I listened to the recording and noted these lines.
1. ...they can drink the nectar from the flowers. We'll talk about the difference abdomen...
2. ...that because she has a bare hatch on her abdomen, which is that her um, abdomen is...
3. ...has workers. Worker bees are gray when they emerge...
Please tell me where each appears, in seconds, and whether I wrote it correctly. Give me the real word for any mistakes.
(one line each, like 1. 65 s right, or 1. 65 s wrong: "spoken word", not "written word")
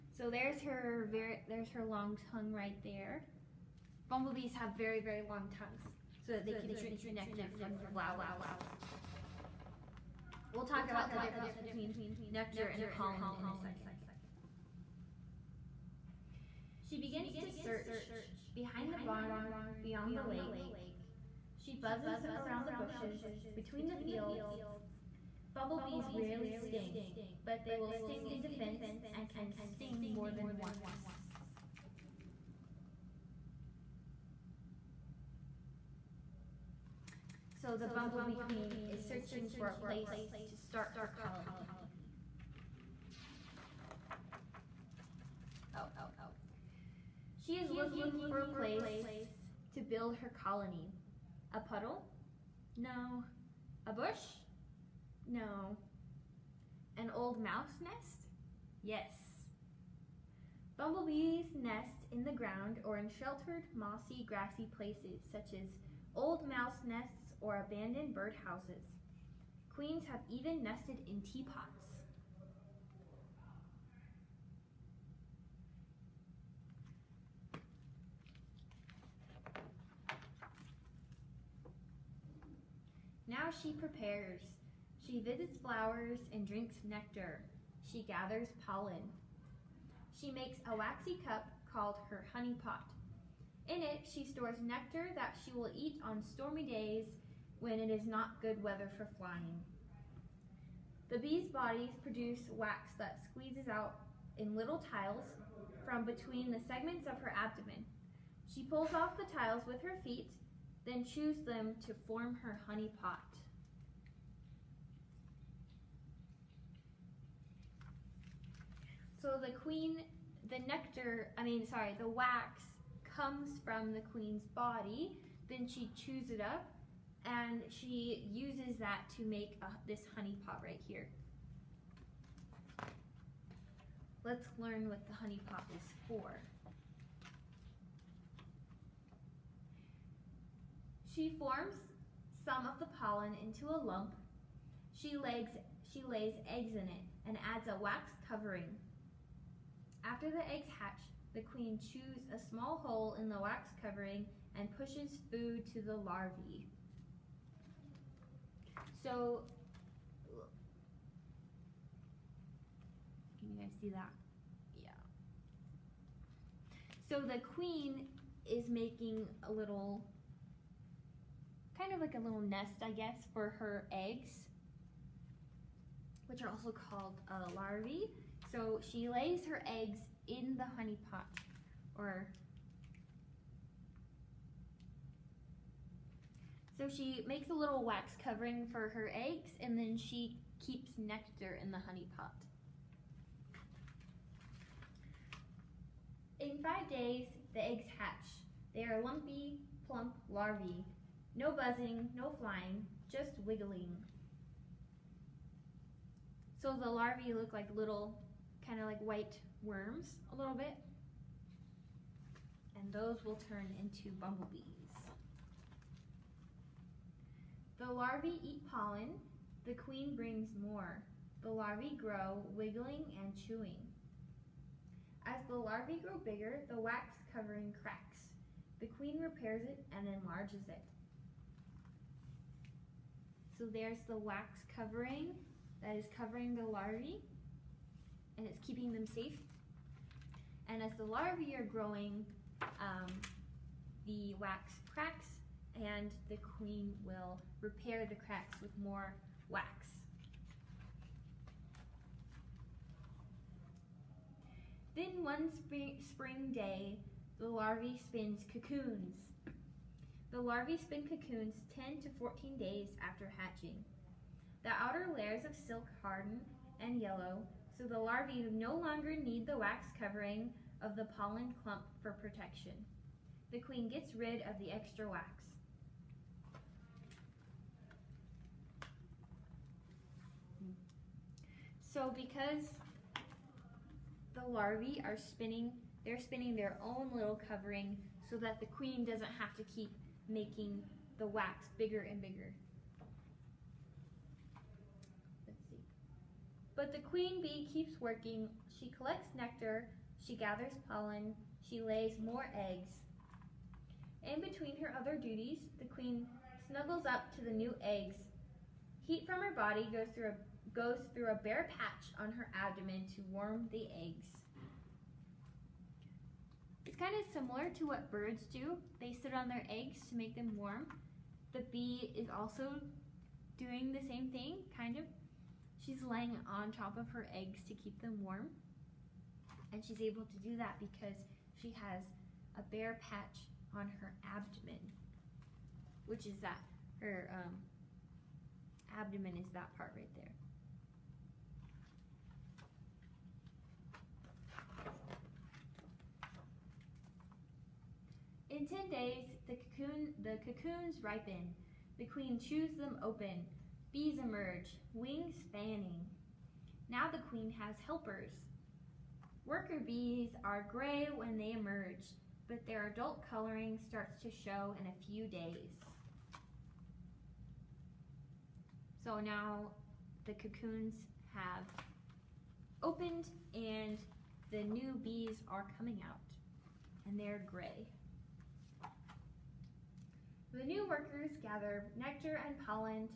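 1. 6 s wrong: "between", not "abdomen"
2. 330 s wrong: "patch", not "hatch"
3. 357 s wrong: "helpers", not "workers".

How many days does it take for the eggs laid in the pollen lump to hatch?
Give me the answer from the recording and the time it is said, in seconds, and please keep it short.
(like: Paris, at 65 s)
5, at 196 s.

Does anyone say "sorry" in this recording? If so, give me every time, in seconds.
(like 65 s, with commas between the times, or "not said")
121 s.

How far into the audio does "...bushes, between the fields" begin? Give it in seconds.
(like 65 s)
22 s.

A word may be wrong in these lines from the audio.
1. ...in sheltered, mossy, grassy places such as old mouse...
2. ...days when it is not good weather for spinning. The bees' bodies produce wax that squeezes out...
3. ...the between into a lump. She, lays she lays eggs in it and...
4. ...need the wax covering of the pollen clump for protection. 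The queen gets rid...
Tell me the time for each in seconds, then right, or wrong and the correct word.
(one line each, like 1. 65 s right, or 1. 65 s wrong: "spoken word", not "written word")
1. 62 s right
2. 96 s wrong: "flying", not "spinning"
3. 142 s wrong: "pollen", not "between"
4. 269 s right.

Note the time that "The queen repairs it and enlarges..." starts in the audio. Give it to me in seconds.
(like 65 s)
228 s.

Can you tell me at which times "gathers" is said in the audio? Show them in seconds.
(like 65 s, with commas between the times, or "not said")
88 s, 300 s, 381 s.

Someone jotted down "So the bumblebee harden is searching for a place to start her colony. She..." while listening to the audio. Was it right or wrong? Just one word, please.
wrong.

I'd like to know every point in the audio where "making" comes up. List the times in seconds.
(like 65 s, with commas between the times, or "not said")
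168 s, 290 s.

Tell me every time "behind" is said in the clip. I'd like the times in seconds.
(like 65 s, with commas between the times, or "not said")
18 s.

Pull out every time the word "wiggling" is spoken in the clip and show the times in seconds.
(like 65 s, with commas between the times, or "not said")
203 s, 222 s.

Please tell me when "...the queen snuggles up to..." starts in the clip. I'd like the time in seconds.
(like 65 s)
305 s.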